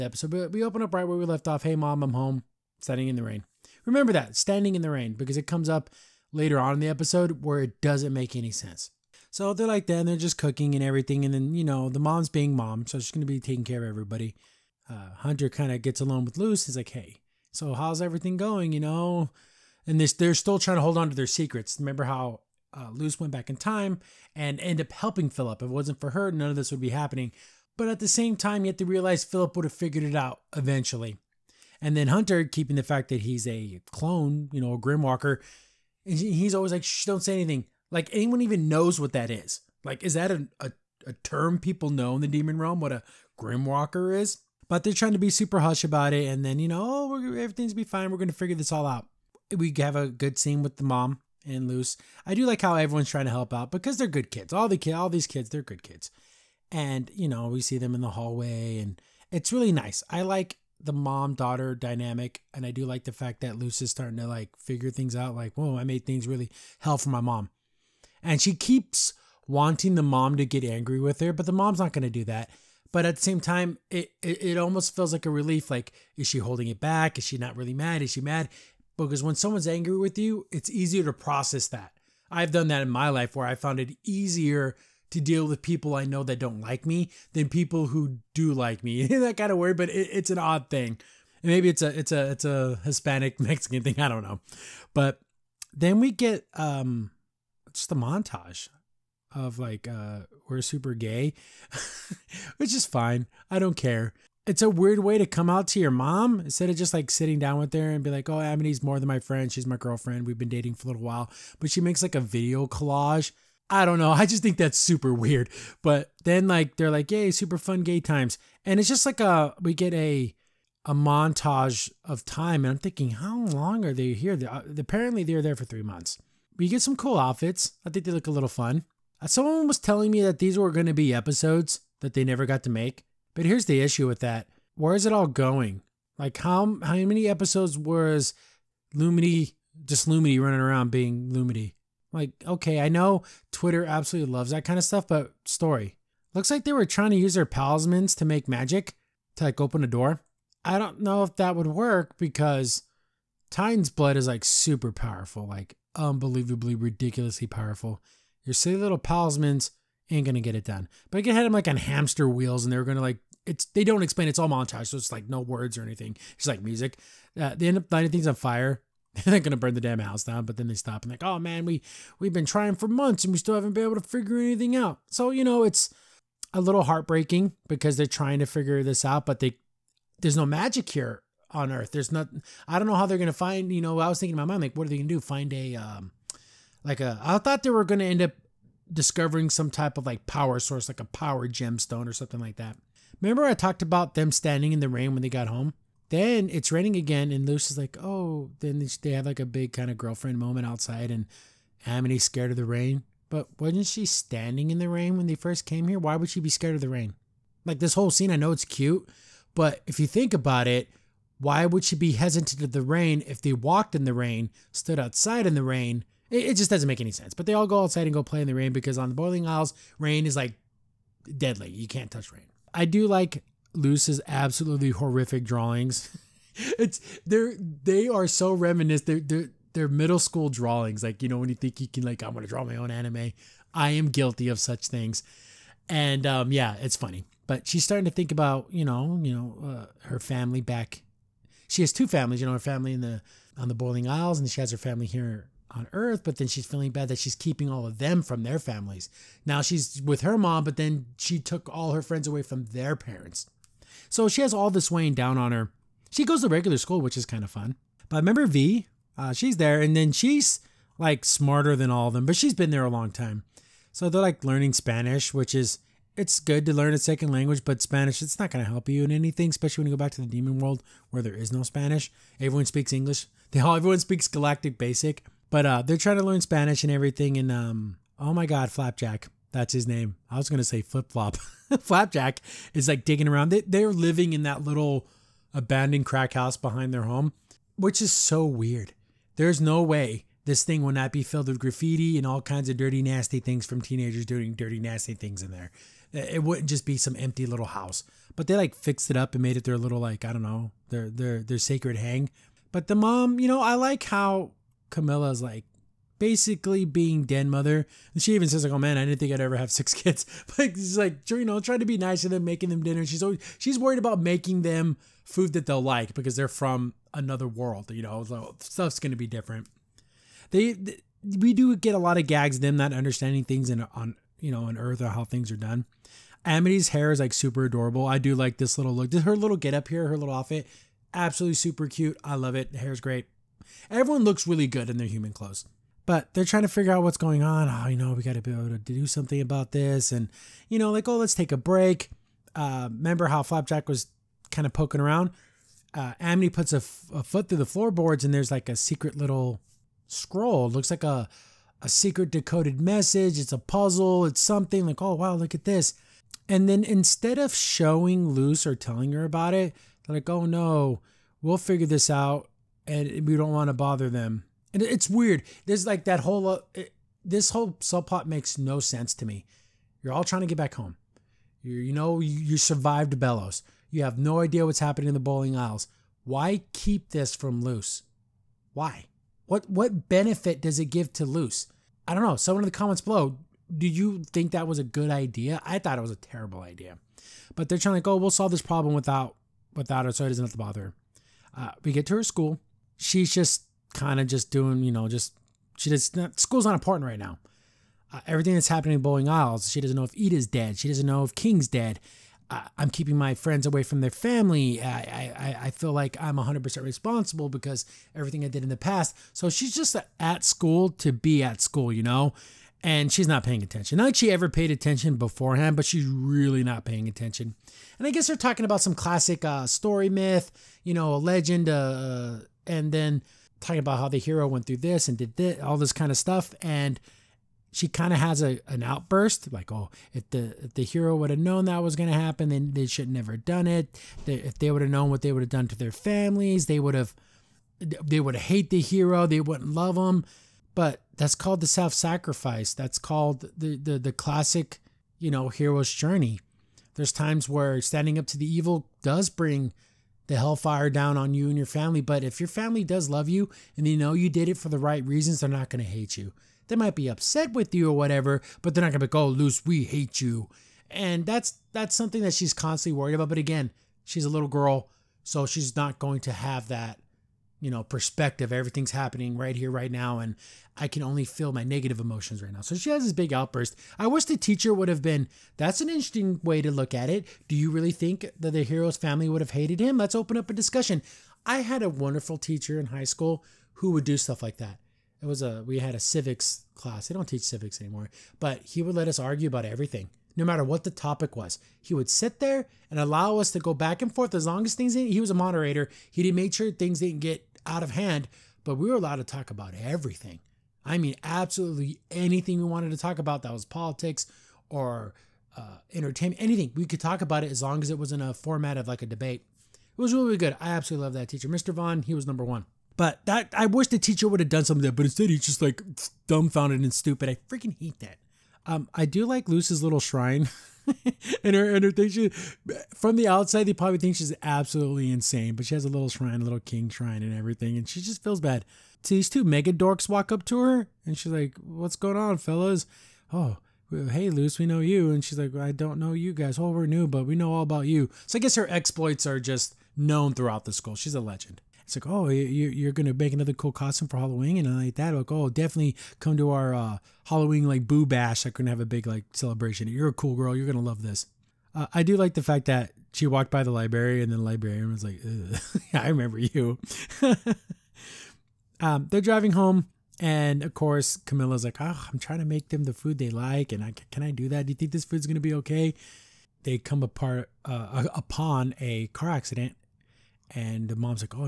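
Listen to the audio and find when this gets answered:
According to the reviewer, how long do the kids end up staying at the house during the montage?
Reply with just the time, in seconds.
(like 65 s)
125 s.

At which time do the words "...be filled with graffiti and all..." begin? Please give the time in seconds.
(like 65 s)
291 s.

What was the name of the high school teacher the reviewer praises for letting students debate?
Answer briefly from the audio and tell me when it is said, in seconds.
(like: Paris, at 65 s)
Mr. Vaughn, at 511 s.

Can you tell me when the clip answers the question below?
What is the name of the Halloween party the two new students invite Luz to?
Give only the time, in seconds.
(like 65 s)
547 s.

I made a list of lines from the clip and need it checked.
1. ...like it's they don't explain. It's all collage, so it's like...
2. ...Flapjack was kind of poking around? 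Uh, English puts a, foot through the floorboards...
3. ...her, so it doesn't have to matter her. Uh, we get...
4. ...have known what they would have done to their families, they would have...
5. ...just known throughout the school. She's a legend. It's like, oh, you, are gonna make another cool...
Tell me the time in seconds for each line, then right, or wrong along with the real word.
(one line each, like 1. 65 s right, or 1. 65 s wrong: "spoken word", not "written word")
1. 163 s wrong: "montage", not "collage"
2. 343 s wrong: "Amity", not "English"
3. 390 s wrong: "bother", not "matter"
4. 434 s right
5. 539 s right.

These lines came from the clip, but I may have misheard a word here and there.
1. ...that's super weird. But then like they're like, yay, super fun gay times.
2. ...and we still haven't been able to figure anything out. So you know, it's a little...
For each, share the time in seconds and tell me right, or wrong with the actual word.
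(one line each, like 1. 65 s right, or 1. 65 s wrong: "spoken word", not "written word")
1. 114 s right
2. 173 s right.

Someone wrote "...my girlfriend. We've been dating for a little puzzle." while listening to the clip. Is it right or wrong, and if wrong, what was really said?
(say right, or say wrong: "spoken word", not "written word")
wrong: "while", not "puzzle".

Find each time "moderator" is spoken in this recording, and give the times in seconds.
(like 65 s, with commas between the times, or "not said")
495 s.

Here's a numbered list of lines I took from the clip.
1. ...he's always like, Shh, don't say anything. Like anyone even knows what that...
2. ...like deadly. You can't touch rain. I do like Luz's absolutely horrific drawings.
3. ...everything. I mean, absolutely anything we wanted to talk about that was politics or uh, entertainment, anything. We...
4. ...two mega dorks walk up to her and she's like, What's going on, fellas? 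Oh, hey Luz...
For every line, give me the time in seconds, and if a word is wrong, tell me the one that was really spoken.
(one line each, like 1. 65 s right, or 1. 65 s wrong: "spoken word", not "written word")
1. 36 s right
2. 220 s right
3. 499 s right
4. 529 s right.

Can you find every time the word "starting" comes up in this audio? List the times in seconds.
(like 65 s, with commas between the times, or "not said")
63 s, 237 s.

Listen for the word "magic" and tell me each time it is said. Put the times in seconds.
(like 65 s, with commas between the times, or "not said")
148 s, 180 s.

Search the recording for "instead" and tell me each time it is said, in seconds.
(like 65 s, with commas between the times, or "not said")
106 s, 356 s, 515 s.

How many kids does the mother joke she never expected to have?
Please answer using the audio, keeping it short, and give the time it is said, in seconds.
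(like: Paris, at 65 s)
6, at 309 s.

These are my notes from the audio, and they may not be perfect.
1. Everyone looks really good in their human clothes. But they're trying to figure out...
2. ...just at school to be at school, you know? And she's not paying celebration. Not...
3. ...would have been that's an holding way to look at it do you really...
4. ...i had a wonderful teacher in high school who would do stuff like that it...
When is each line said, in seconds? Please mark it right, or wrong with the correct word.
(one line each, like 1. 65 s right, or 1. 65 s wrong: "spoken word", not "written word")
1. 333 s right
2. 409 s wrong: "attention", not "celebration"
3. 474 s wrong: "interesting", not "holding"
4. 481 s right.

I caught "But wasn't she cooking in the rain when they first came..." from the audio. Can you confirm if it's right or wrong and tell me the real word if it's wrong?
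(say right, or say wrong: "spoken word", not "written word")
wrong: "standing", not "cooking".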